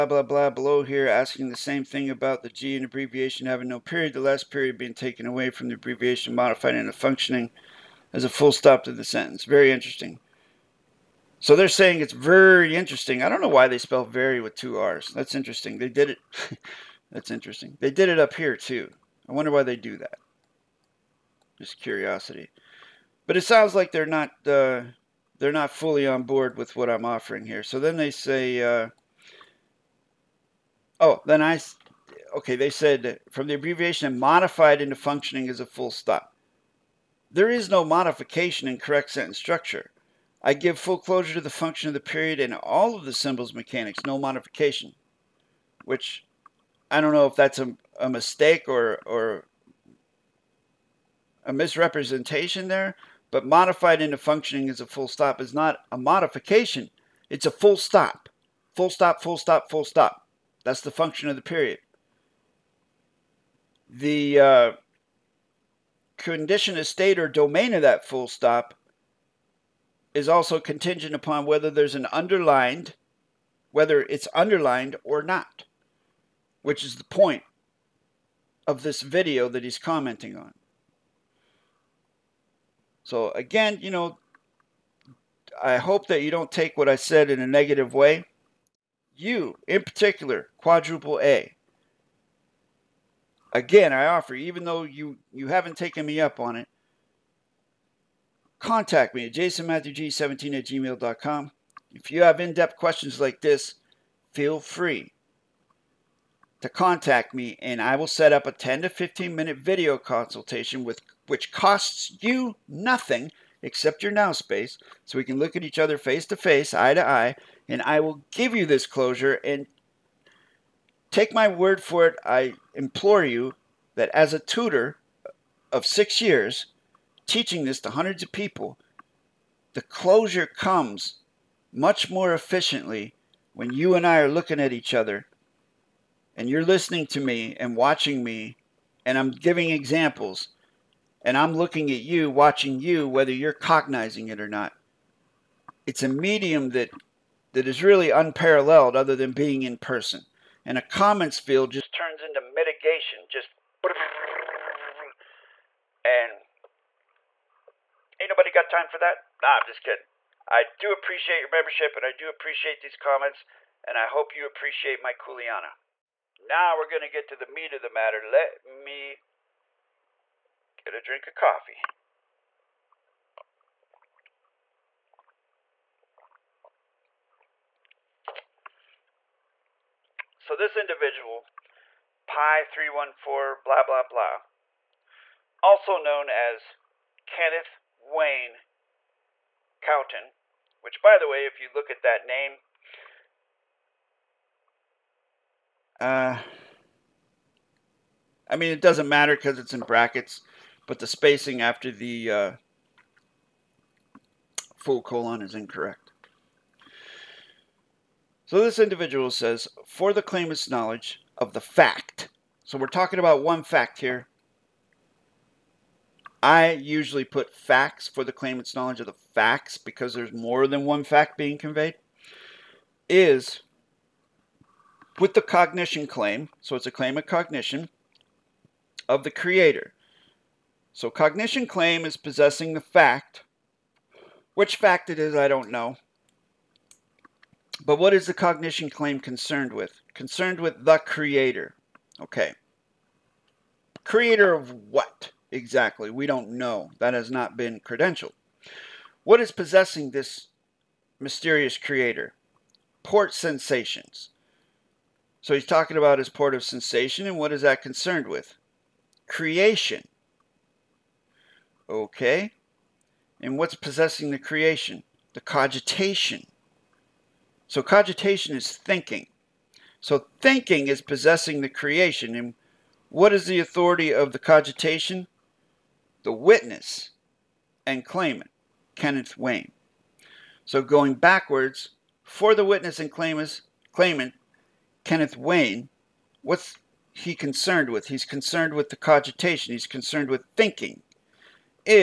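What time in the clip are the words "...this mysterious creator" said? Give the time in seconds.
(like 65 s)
250 s.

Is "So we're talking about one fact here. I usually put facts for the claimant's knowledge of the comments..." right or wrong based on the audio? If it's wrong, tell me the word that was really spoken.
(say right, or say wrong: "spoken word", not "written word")
wrong: "facts", not "comments".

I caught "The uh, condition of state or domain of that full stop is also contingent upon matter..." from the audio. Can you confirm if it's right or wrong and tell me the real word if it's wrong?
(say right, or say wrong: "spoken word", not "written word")
wrong: "whether", not "matter".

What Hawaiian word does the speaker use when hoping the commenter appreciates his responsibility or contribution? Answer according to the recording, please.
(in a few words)
Kuleana.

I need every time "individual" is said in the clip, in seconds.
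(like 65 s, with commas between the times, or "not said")
180 s, 208 s.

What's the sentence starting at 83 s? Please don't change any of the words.
So again, you know, I hope that you don't take what I said in a negative way.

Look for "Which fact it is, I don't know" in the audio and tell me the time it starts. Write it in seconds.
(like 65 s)
234 s.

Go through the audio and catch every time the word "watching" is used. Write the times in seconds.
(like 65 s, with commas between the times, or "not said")
137 s, 142 s.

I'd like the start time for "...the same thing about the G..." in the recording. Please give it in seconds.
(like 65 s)
1 s.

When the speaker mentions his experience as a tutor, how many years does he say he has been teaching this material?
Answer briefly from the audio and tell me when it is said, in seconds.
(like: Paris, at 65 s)
6, at 125 s.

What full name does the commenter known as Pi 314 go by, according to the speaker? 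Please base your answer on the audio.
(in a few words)
Kenneth Wayne Cowton.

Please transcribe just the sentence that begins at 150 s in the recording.
And a comments field just turns into mitigation, just and ain't nobody got time for that.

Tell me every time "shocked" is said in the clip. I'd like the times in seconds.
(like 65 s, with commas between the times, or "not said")
not said.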